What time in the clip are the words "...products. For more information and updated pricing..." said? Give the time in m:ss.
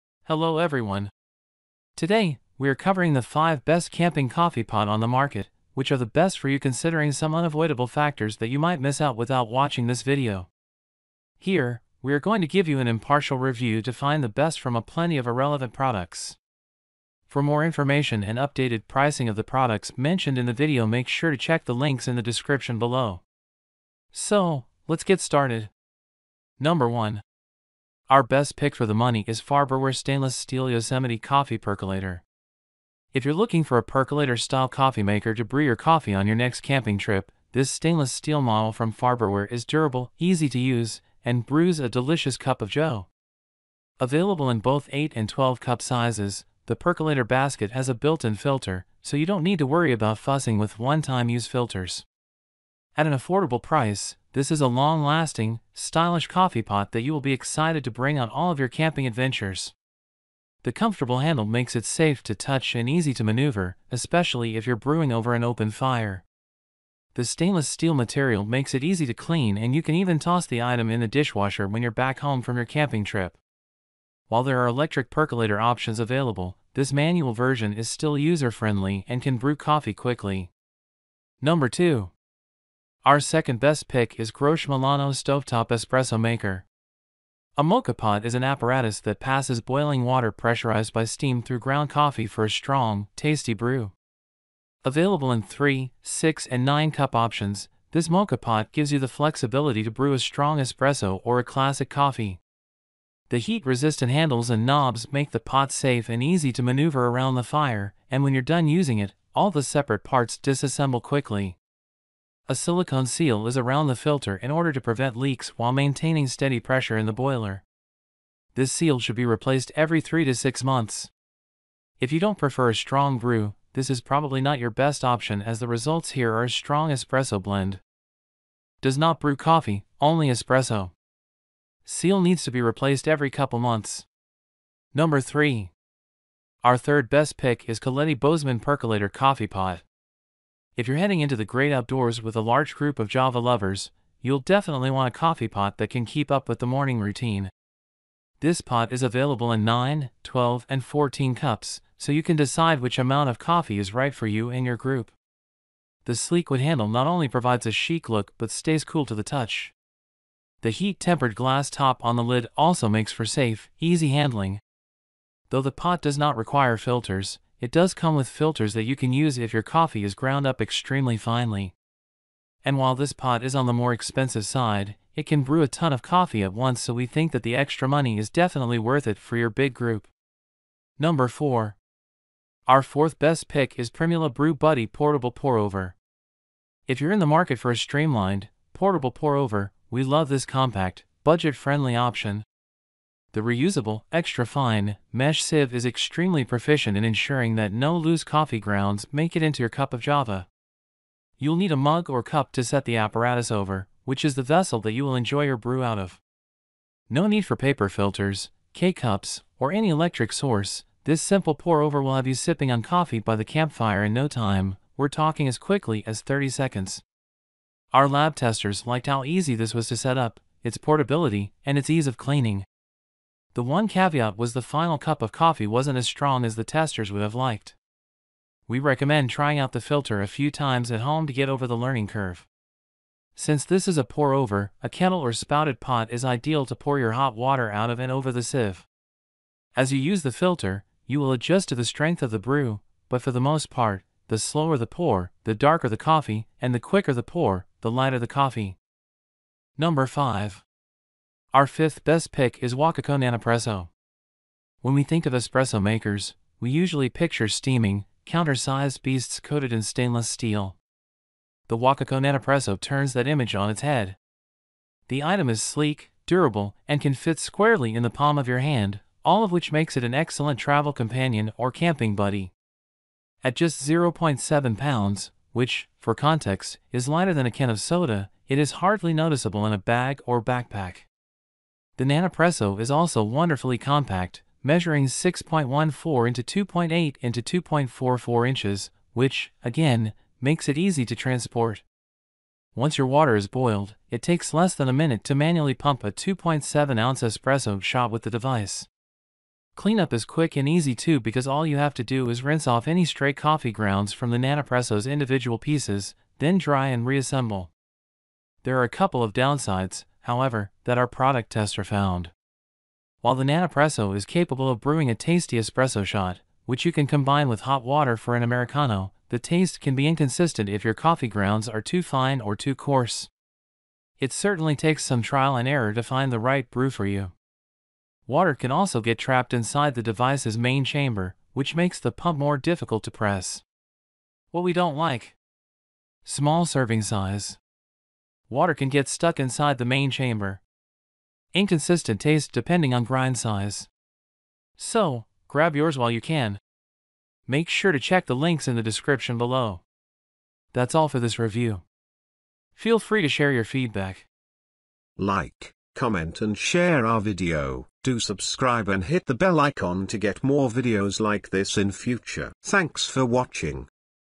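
0:15.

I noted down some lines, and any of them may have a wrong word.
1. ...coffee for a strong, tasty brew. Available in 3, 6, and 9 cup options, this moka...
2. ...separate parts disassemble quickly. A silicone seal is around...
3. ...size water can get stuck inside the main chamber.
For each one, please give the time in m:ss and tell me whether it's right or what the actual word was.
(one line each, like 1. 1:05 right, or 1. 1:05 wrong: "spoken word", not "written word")
1. 1:31 right
2. 1:49 right
3. 5:37 right.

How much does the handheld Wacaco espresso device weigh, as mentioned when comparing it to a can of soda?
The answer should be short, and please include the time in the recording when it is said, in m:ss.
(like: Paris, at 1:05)
0.7 pounds, at 4:33.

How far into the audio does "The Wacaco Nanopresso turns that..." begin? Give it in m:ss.
4:21.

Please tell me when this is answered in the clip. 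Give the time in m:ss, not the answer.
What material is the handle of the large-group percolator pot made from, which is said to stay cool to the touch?
2:36.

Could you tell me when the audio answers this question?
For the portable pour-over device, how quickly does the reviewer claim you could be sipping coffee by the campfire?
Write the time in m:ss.
3:36.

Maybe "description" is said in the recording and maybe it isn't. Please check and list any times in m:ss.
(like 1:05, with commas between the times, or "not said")
0:22, 5:48.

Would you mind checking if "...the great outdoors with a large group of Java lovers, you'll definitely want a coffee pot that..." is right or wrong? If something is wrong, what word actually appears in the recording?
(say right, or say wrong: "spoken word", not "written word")
right.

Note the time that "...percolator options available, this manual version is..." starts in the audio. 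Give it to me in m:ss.
1:15.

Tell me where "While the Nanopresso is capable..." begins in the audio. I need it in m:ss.
5:13.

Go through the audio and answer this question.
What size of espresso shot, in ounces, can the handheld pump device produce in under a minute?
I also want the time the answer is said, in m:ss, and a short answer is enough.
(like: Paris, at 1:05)
2.7 ounces, at 4:56.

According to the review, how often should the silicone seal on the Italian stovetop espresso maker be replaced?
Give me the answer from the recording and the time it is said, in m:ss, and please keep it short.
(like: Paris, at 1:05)
every 3 to 6 months, at 1:59.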